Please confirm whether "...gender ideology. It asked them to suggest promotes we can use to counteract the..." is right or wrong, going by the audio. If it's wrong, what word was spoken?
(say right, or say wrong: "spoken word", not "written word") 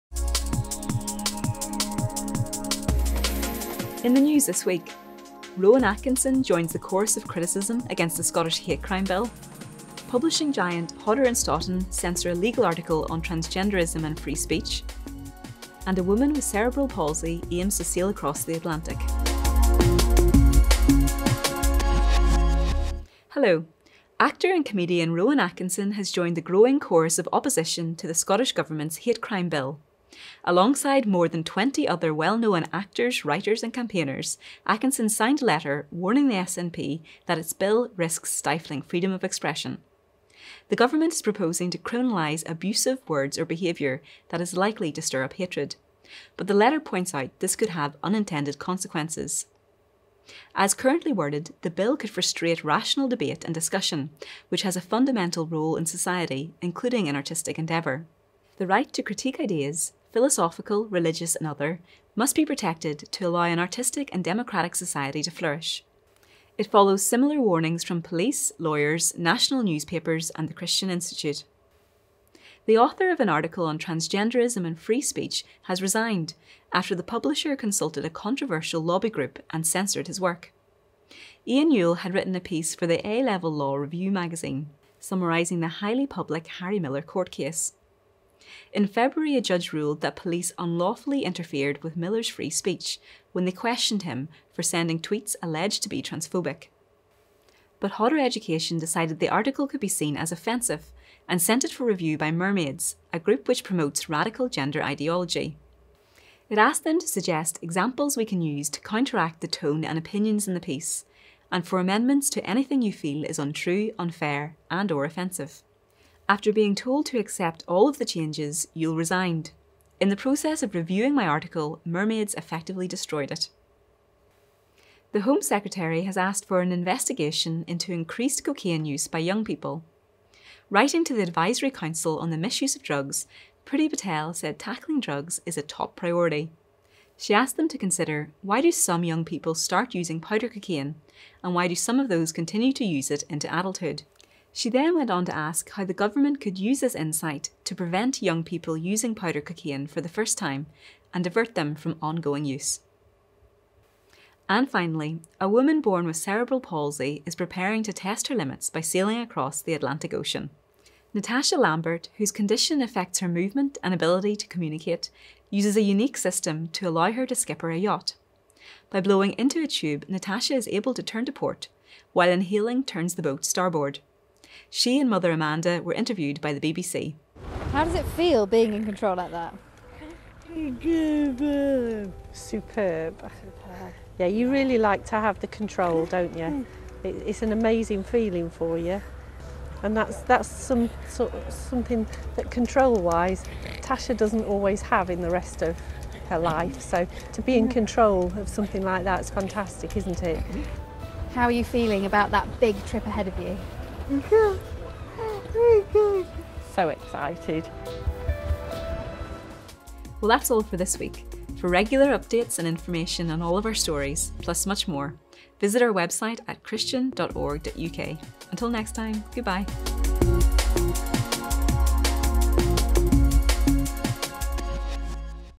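wrong: "examples", not "promotes".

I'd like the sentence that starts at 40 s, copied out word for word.
The government is proposing to criminalise abusive words or behaviour that is likely to stir up hatred.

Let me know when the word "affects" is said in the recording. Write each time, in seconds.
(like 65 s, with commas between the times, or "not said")
162 s.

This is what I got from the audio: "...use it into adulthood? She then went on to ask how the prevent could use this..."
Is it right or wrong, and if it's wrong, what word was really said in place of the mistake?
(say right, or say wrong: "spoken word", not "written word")
wrong: "government", not "prevent".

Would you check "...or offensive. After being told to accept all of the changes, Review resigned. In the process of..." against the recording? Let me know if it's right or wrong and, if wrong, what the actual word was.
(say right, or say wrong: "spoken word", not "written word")
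wrong: "Yule", not "Review".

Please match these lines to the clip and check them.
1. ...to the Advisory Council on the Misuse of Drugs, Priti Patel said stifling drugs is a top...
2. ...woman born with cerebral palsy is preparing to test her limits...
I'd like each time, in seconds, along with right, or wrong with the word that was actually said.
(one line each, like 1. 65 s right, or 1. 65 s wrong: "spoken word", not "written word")
1. 131 s wrong: "tackling", not "stifling"
2. 155 s right.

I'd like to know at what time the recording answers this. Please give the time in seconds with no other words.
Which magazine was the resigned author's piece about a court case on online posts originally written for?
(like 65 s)
83 s.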